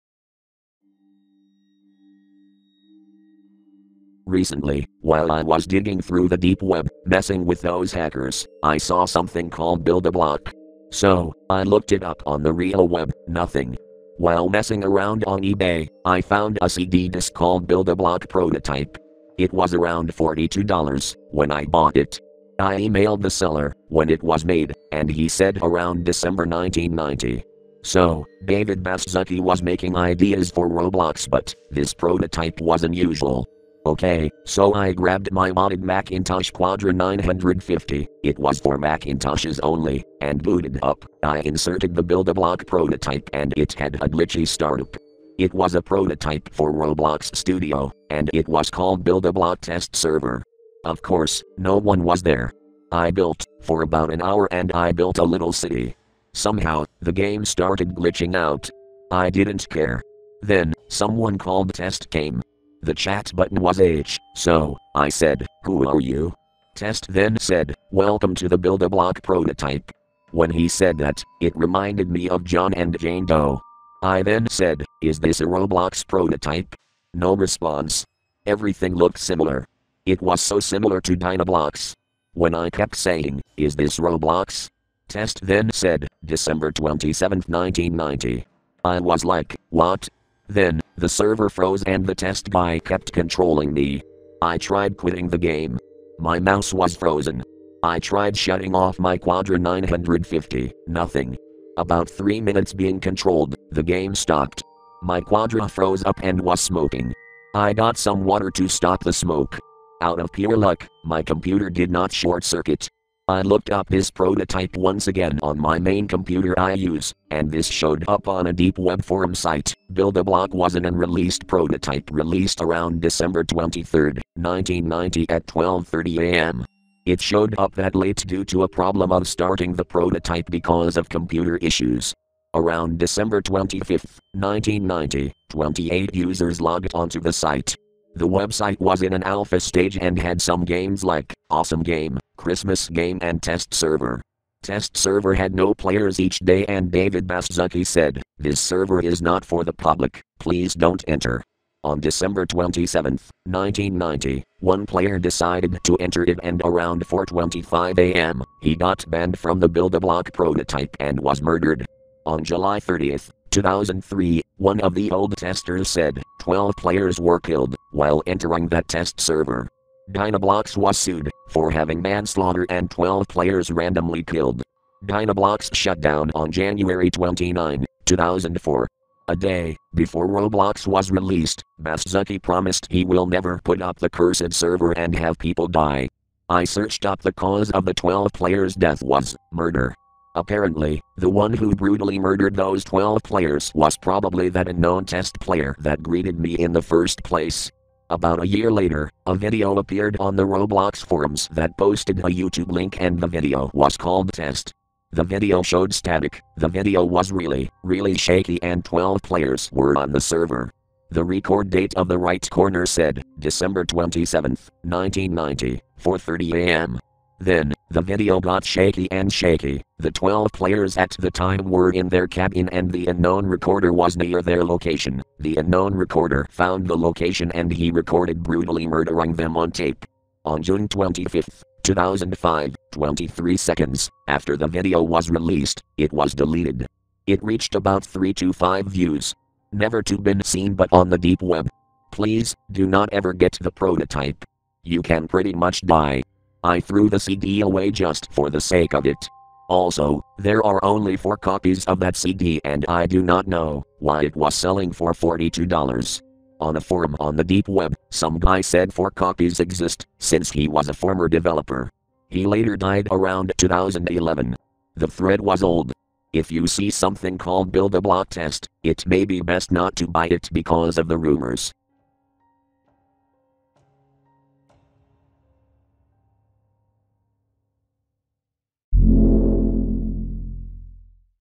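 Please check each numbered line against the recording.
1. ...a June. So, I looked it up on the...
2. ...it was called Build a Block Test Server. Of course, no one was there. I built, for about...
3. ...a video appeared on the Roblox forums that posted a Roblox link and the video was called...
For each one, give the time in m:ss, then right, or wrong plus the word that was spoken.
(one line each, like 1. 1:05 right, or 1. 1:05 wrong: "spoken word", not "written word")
1. 0:10 wrong: "Block", not "June"
2. 0:48 right
3. 3:19 wrong: "YouTube", not "Roblox".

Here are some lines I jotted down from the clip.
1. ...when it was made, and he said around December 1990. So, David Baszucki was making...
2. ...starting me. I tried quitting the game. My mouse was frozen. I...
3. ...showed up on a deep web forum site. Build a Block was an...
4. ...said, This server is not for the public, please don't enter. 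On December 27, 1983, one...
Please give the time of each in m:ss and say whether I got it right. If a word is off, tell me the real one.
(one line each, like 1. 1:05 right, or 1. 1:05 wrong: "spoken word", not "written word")
1. 0:23 right
2. 1:33 wrong: "controlling", not "starting"
3. 1:57 right
4. 2:27 wrong: "1990", not "1983".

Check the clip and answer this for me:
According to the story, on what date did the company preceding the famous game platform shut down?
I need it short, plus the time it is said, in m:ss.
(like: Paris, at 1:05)
January 29, 2004, at 2:56.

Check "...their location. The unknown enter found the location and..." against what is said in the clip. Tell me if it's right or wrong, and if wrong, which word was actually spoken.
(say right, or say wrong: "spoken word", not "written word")
wrong: "recorder", not "enter".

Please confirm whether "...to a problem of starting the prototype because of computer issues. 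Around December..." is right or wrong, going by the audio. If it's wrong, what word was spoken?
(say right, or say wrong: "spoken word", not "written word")
right.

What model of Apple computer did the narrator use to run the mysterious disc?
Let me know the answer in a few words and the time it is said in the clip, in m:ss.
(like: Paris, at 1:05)
Macintosh Quadra 950, at 0:35.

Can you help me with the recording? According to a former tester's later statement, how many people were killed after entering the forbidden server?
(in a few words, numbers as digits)
12.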